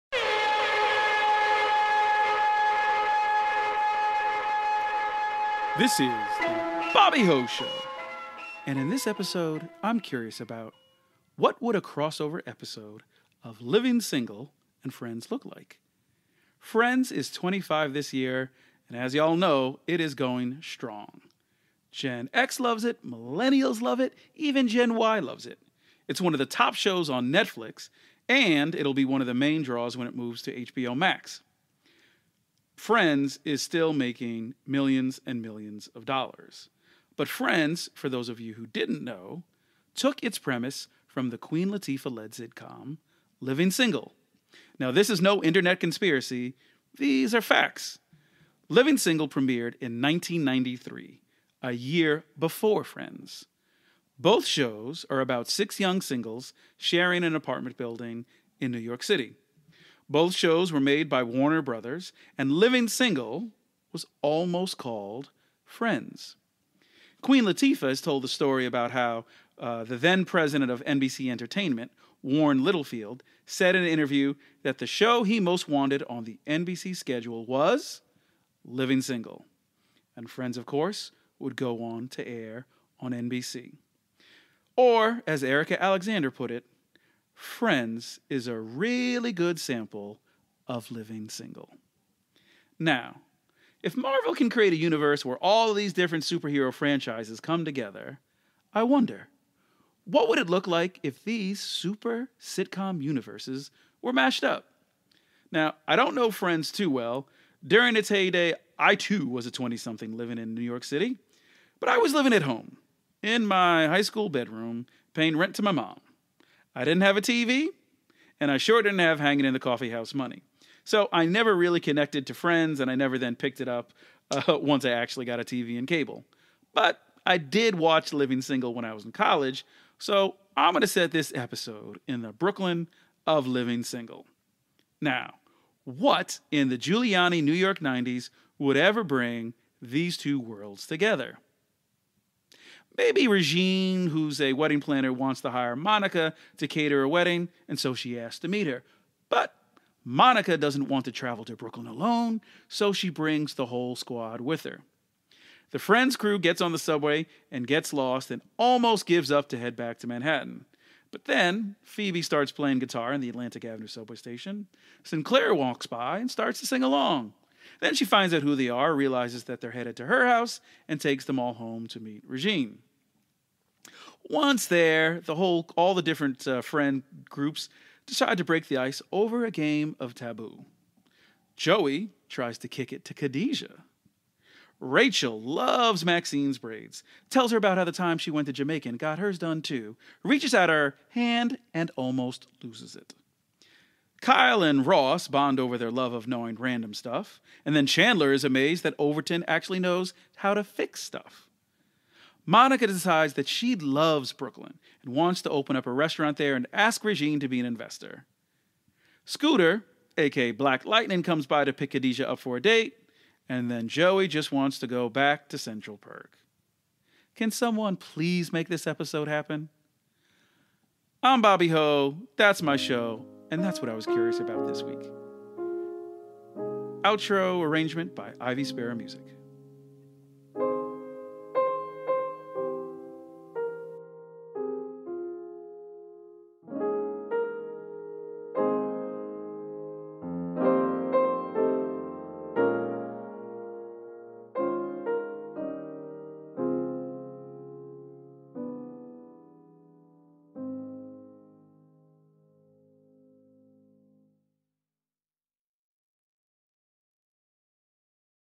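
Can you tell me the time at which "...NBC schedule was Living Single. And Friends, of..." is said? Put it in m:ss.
1:16.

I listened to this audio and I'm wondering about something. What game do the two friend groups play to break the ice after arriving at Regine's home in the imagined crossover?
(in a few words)
Taboo.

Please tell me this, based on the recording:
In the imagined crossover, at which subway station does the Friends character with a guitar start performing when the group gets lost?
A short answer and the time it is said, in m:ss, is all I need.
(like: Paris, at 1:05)
Atlantic Avenue, at 2:43.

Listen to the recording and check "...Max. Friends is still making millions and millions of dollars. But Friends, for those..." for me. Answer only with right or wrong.
right.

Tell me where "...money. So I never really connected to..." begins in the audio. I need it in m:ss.
2:00.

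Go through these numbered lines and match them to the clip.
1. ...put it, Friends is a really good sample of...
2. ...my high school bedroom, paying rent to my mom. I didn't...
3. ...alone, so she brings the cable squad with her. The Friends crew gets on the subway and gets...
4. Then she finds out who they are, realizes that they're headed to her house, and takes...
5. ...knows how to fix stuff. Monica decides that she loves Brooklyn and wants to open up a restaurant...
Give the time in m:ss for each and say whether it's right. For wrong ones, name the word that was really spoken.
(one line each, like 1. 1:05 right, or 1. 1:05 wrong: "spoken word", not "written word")
1. 1:26 right
2. 1:53 right
3. 2:31 wrong: "whole", not "cable"
4. 2:47 right
5. 3:19 right.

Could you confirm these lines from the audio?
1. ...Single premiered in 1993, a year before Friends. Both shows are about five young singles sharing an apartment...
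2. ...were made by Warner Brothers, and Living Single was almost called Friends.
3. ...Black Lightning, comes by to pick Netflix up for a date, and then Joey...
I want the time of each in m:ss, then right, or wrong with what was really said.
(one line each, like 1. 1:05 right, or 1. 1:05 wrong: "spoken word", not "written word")
1. 0:48 wrong: "six", not "five"
2. 1:00 right
3. 3:30 wrong: "Khadijah", not "Netflix".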